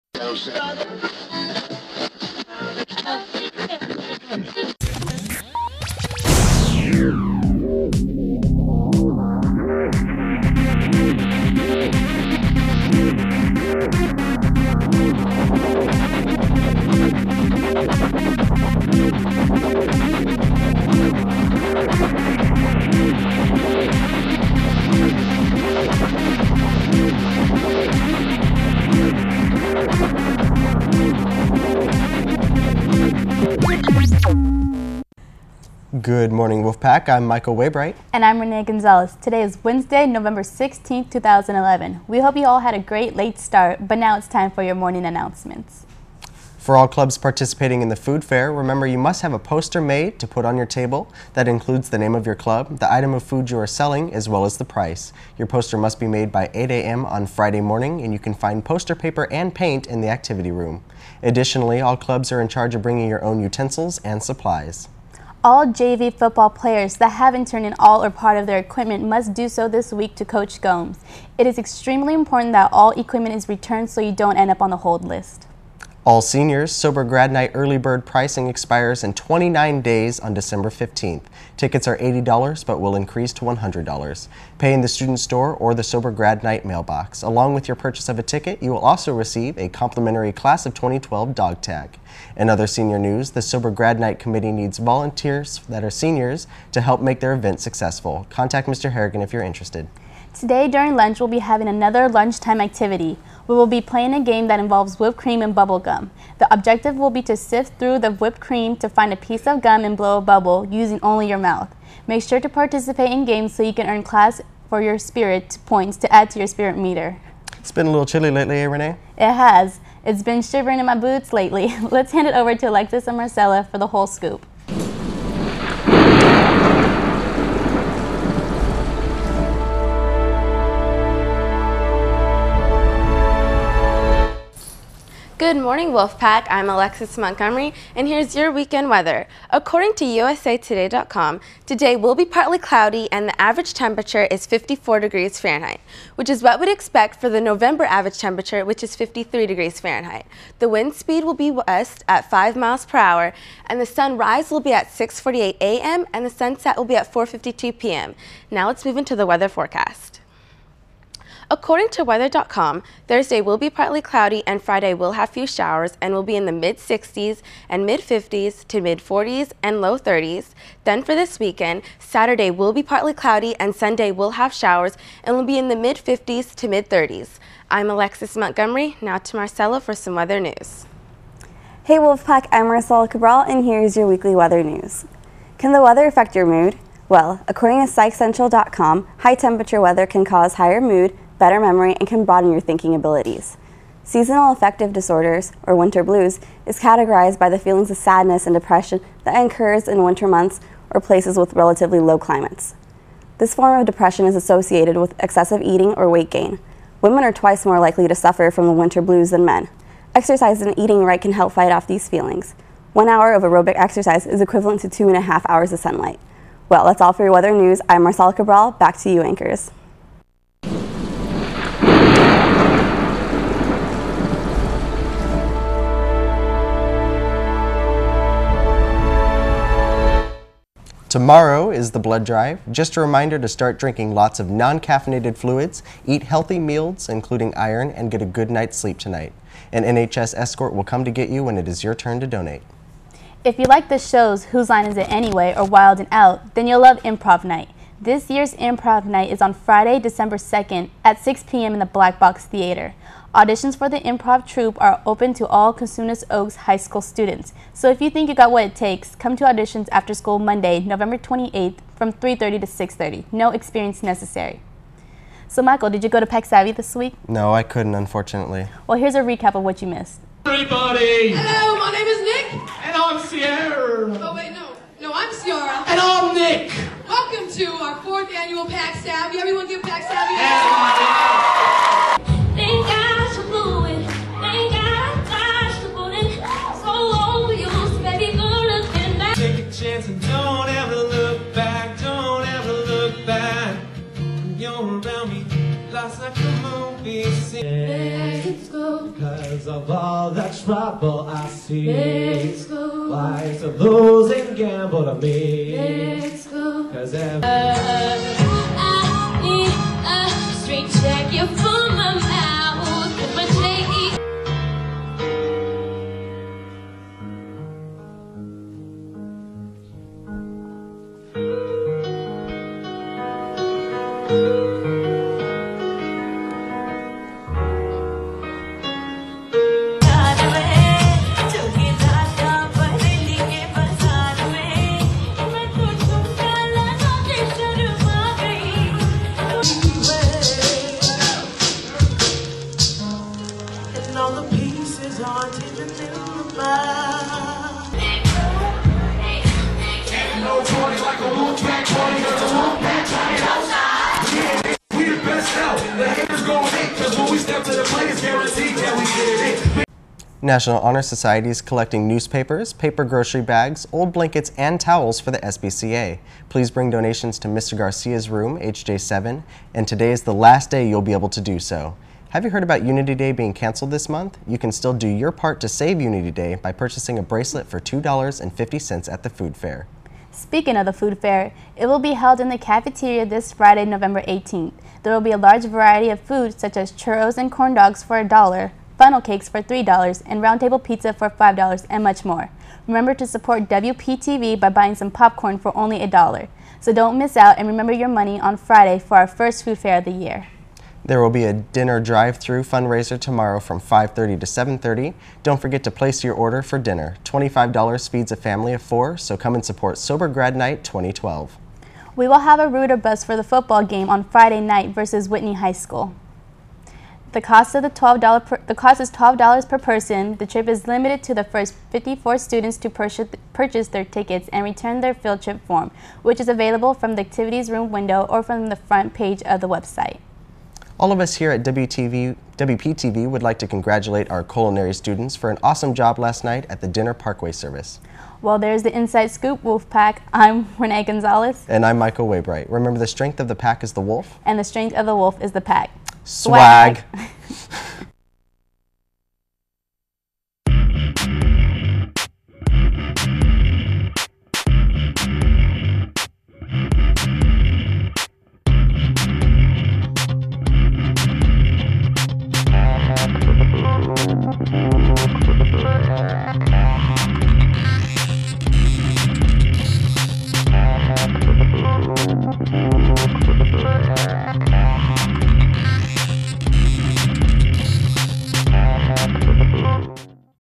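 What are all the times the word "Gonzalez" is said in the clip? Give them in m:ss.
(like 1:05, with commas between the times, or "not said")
0:38, 7:21.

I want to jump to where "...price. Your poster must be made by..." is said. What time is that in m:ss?
0:54.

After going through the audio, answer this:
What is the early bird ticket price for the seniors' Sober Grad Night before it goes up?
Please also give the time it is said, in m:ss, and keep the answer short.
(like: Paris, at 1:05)
$80, at 1:21.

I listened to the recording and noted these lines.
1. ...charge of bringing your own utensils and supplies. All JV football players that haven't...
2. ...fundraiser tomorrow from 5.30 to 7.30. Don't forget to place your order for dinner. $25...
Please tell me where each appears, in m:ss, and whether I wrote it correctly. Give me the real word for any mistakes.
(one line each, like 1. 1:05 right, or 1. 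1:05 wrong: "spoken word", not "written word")
1. 1:02 right
2. 6:42 right.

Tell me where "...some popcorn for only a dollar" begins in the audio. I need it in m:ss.
6:34.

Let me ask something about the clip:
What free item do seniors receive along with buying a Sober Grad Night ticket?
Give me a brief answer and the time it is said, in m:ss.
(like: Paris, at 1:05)
Class of 2012 dog tag, at 1:30.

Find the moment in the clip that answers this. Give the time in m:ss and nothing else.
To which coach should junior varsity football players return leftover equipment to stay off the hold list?
1:10.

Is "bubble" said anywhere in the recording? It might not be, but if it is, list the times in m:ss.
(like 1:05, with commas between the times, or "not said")
1:45, 1:50.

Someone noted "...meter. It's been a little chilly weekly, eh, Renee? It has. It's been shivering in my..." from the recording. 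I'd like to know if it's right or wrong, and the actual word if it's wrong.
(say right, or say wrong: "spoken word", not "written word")
wrong: "lately", not "weekly".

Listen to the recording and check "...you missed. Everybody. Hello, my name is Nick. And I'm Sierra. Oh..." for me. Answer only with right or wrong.
right.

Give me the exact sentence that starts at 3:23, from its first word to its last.
This form of depression is associated with excessive eating or weight gain.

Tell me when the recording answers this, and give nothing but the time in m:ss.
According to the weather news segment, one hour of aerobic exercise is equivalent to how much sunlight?
3:34.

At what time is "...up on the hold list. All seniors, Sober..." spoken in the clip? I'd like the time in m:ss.
1:14.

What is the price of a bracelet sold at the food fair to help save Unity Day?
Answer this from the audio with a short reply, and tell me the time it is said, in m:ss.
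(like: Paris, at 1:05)
$2.50, at 6:17.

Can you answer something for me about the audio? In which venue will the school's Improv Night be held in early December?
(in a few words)
Black Box Theater.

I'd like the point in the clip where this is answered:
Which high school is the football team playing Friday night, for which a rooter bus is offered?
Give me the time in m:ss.
6:55.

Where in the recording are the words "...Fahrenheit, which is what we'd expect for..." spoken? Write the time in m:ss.
2:25.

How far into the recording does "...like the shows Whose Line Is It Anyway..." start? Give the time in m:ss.
4:03.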